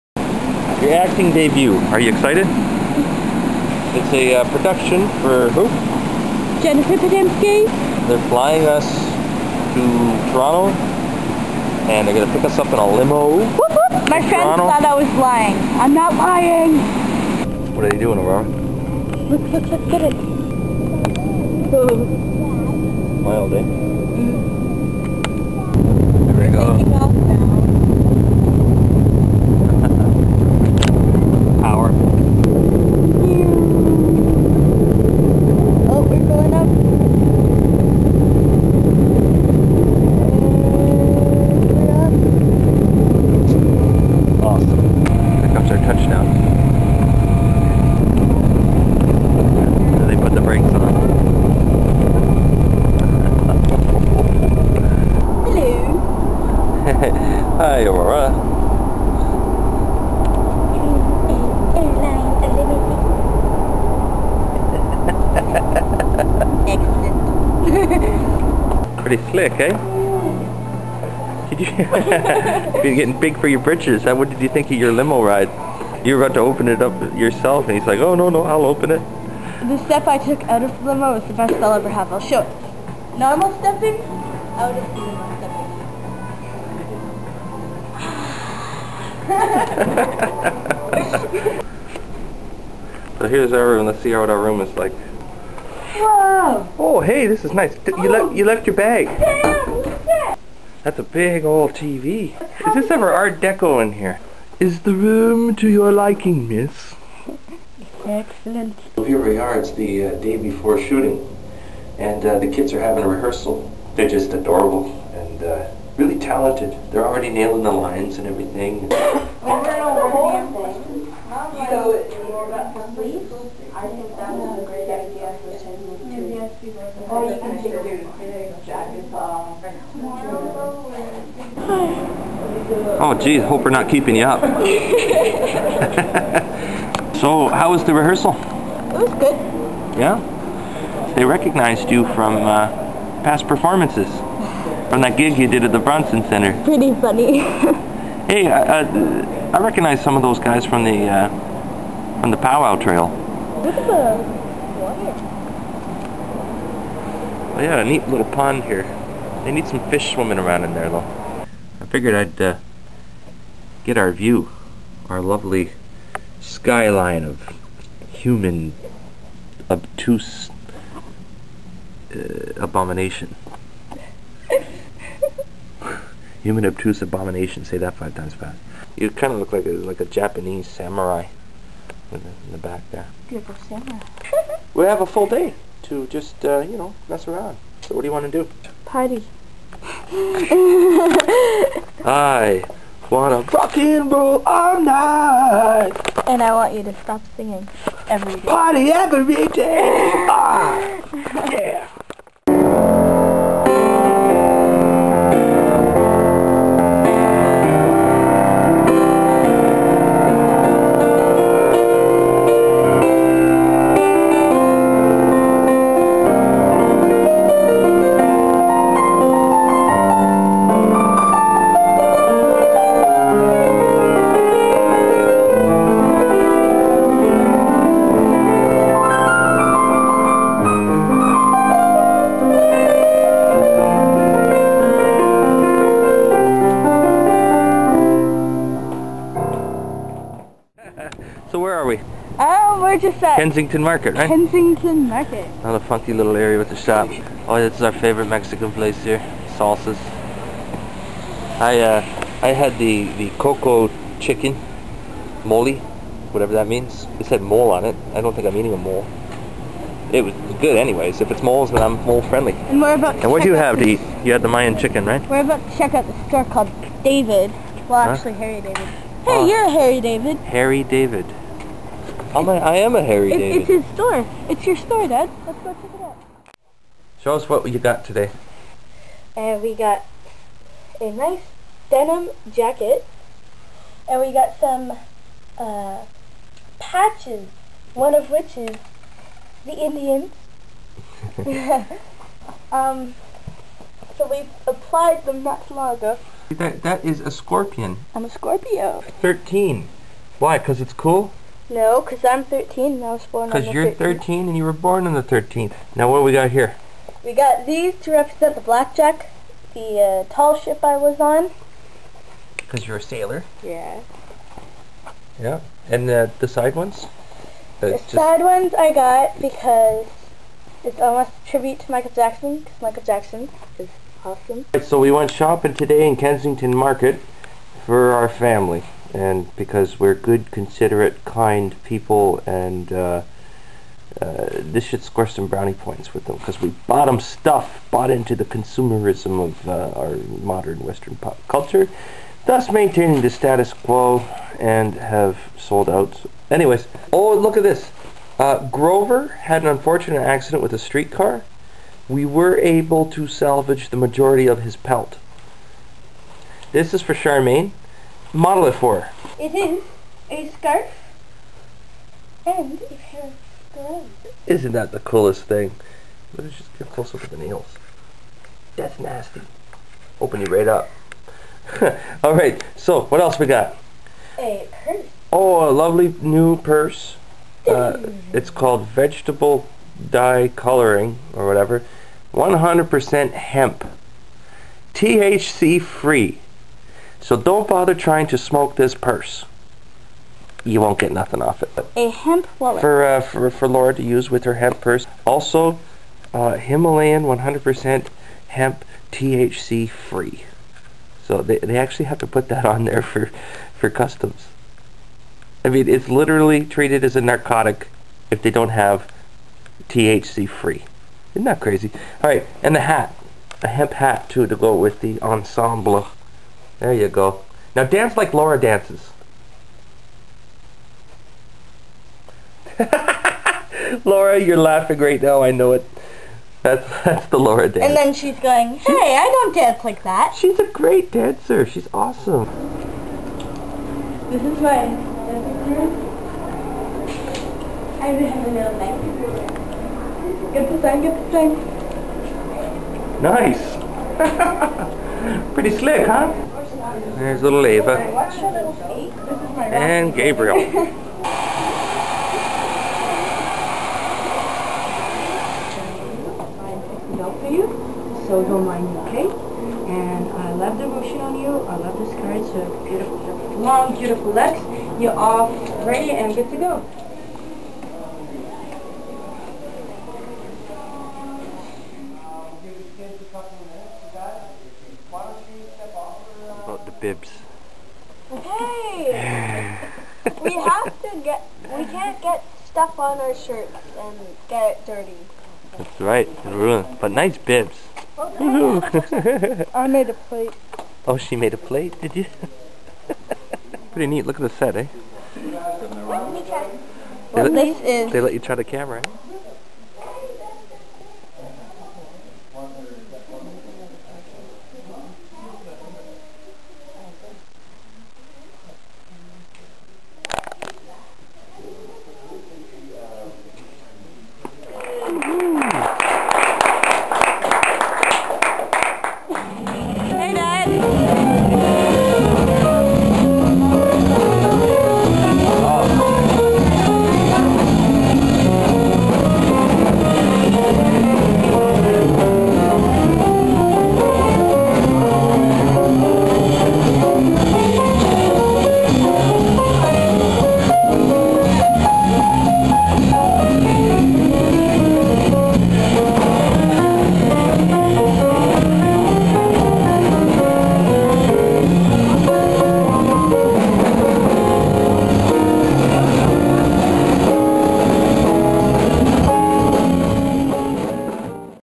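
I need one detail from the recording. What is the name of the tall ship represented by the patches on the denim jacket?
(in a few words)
Blackjack.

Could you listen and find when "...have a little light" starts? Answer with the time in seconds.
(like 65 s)
438 s.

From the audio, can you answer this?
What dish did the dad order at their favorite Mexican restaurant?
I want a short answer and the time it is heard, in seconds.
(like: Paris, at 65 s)
coco chicken mole, at 253 s.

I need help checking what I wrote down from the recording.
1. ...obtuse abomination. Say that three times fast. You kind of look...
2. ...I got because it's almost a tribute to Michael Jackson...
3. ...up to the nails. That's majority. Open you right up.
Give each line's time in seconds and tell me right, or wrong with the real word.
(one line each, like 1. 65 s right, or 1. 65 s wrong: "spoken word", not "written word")
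1. 176 s wrong: "five", not "three"
2. 318 s right
3. 367 s wrong: "nasty", not "majority".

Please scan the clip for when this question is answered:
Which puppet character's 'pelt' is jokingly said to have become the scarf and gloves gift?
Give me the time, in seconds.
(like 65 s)
348 s.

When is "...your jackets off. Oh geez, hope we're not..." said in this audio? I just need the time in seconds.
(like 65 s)
127 s.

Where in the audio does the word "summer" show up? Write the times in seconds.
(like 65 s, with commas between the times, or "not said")
183 s.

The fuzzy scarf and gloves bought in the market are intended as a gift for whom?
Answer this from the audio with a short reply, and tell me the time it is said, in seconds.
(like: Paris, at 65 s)
Charmaine, at 357 s.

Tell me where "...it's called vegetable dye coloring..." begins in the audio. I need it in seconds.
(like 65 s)
378 s.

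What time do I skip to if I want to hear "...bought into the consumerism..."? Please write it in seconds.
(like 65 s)
337 s.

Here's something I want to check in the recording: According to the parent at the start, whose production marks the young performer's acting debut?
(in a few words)
Jennifer Podemski.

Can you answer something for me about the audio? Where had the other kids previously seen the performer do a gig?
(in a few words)
Bronson Center.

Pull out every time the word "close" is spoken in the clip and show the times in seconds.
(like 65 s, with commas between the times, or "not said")
366 s.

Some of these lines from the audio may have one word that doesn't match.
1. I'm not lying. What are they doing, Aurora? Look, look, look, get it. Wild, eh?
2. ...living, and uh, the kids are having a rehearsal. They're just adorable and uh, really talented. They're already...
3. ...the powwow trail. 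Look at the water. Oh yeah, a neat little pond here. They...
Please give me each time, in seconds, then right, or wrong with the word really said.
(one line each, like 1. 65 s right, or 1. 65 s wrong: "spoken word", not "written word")
1. 15 s right
2. 110 s wrong: "shooting", not "living"
3. 152 s right.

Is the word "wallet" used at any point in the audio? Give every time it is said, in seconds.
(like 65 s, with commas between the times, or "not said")
392 s.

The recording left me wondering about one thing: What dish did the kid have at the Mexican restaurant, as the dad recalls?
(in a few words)
Mayan chicken.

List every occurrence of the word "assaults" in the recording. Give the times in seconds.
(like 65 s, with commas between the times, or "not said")
not said.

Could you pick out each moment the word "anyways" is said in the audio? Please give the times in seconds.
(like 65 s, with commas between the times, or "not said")
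260 s, 346 s.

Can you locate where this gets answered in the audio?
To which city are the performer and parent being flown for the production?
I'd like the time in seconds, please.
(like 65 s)
10 s.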